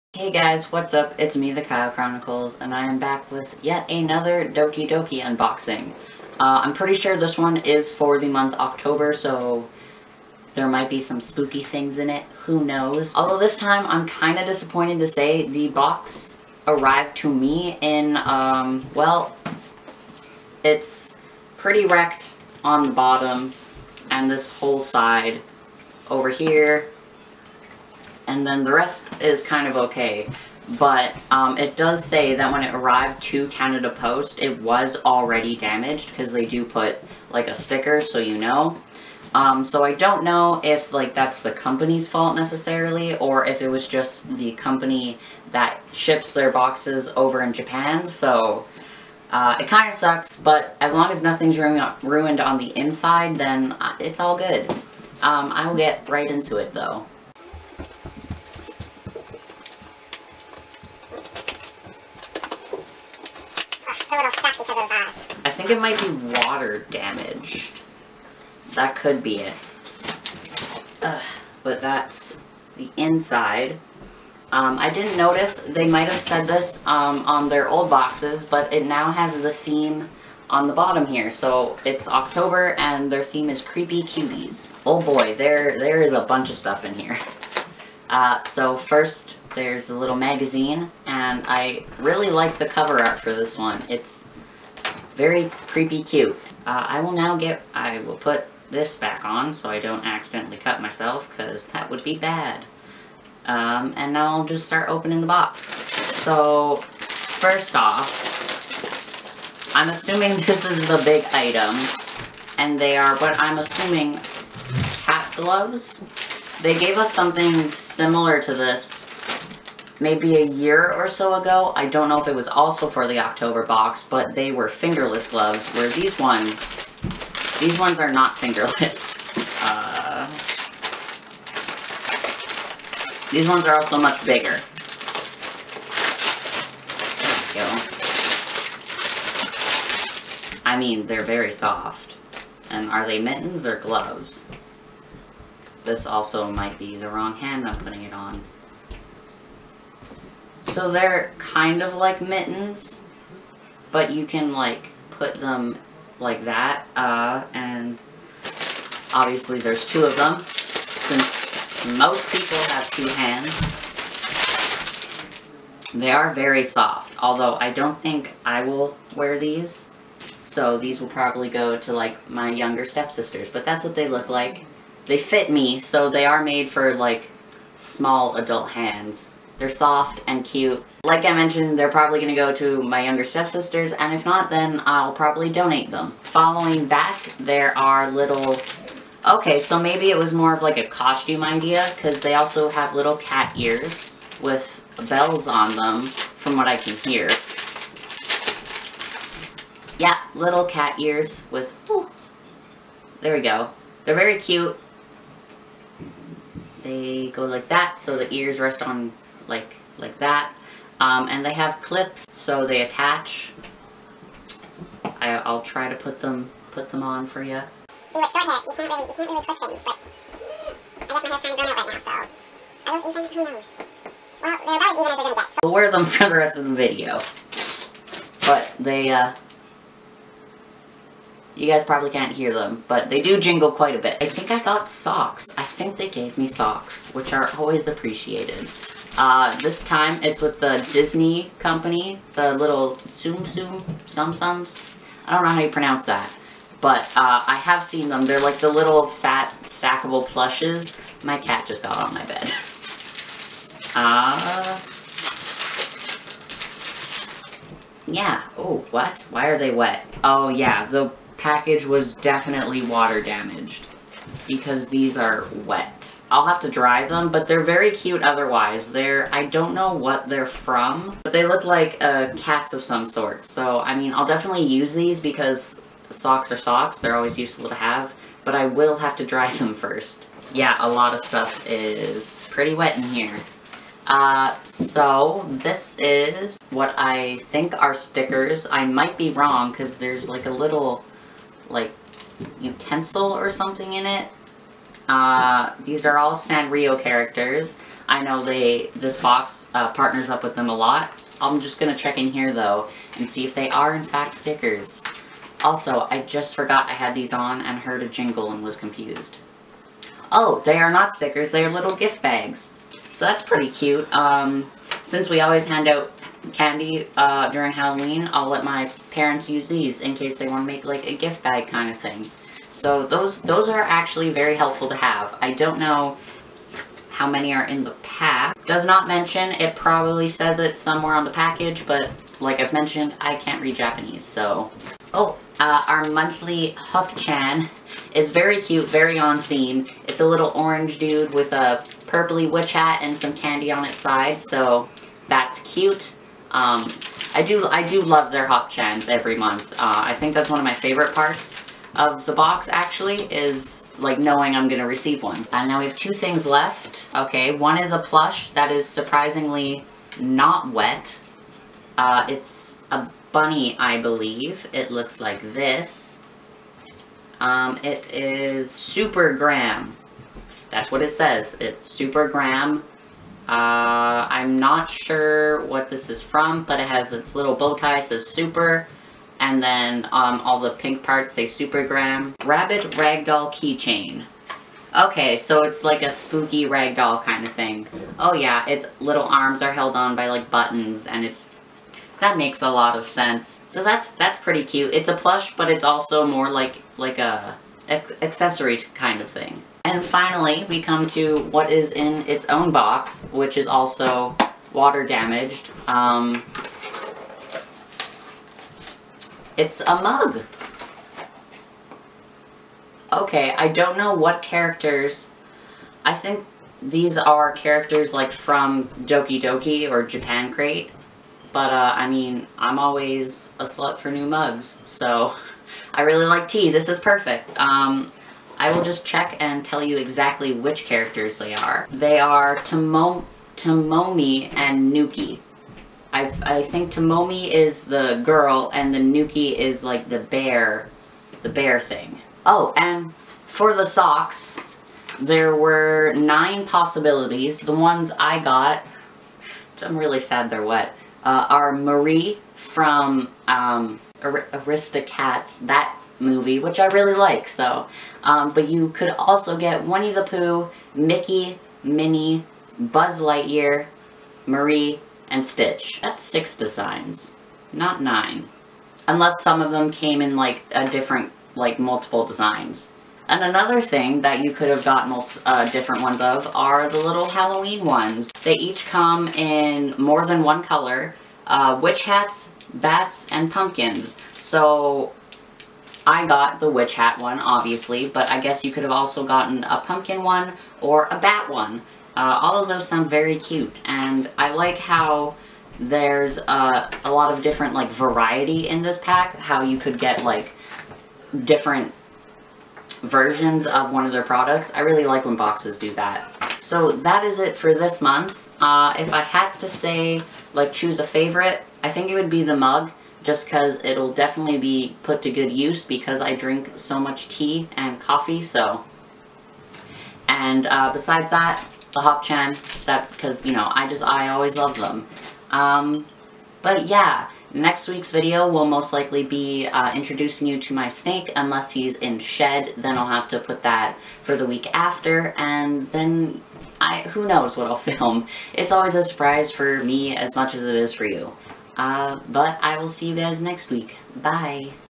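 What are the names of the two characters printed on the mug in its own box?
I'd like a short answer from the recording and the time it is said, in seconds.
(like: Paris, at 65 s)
Tomomi and Nuki, at 433 s.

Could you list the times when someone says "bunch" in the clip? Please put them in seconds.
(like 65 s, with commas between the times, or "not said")
86 s.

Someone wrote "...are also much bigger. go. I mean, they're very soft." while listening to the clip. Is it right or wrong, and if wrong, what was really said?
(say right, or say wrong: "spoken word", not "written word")
right.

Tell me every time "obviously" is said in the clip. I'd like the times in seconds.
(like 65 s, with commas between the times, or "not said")
159 s, 487 s.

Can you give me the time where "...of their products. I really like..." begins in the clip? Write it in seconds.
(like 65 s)
504 s.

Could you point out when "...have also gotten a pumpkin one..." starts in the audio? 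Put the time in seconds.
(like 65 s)
488 s.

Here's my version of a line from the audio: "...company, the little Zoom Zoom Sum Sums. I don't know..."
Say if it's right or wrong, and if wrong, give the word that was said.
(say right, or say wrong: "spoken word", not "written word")
right.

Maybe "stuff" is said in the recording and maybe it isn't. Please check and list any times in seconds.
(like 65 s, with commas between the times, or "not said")
86 s, 281 s.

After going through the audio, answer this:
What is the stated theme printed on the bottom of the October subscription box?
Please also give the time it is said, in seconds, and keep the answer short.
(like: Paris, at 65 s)
Creepy Cuties, at 83 s.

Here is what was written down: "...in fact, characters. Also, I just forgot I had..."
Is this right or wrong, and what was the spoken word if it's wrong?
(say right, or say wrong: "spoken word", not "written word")
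wrong: "stickers", not "characters".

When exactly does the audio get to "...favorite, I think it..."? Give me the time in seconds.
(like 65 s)
511 s.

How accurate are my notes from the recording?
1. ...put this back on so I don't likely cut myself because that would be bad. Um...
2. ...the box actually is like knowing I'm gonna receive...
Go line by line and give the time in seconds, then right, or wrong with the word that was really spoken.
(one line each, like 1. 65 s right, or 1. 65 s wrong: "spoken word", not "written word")
1. 98 s wrong: "accidentally", not "likely"
2. 352 s right.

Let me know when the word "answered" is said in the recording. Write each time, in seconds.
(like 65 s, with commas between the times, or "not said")
not said.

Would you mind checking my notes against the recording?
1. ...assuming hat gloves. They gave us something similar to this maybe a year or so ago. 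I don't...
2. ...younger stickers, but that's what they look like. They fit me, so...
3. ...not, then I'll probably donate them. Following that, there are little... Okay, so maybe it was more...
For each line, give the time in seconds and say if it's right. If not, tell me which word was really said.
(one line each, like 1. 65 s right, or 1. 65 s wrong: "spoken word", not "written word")
1. 113 s right
2. 172 s wrong: "stepsisters", not "stickers"
3. 184 s right.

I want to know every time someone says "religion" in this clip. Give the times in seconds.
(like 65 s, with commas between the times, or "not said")
not said.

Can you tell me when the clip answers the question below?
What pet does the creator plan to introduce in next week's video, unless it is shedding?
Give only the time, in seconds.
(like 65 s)
530 s.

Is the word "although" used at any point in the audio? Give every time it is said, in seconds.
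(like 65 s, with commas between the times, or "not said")
13 s, 167 s.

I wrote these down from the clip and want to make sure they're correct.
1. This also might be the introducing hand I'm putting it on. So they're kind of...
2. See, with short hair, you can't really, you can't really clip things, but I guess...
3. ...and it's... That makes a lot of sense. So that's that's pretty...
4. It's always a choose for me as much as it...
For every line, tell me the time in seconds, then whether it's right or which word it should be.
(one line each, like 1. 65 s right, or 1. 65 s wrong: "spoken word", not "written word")
1. 145 s wrong: "wrong", not "introducing"
2. 218 s right
3. 391 s right
4. 538 s wrong: "surprise", not "choose".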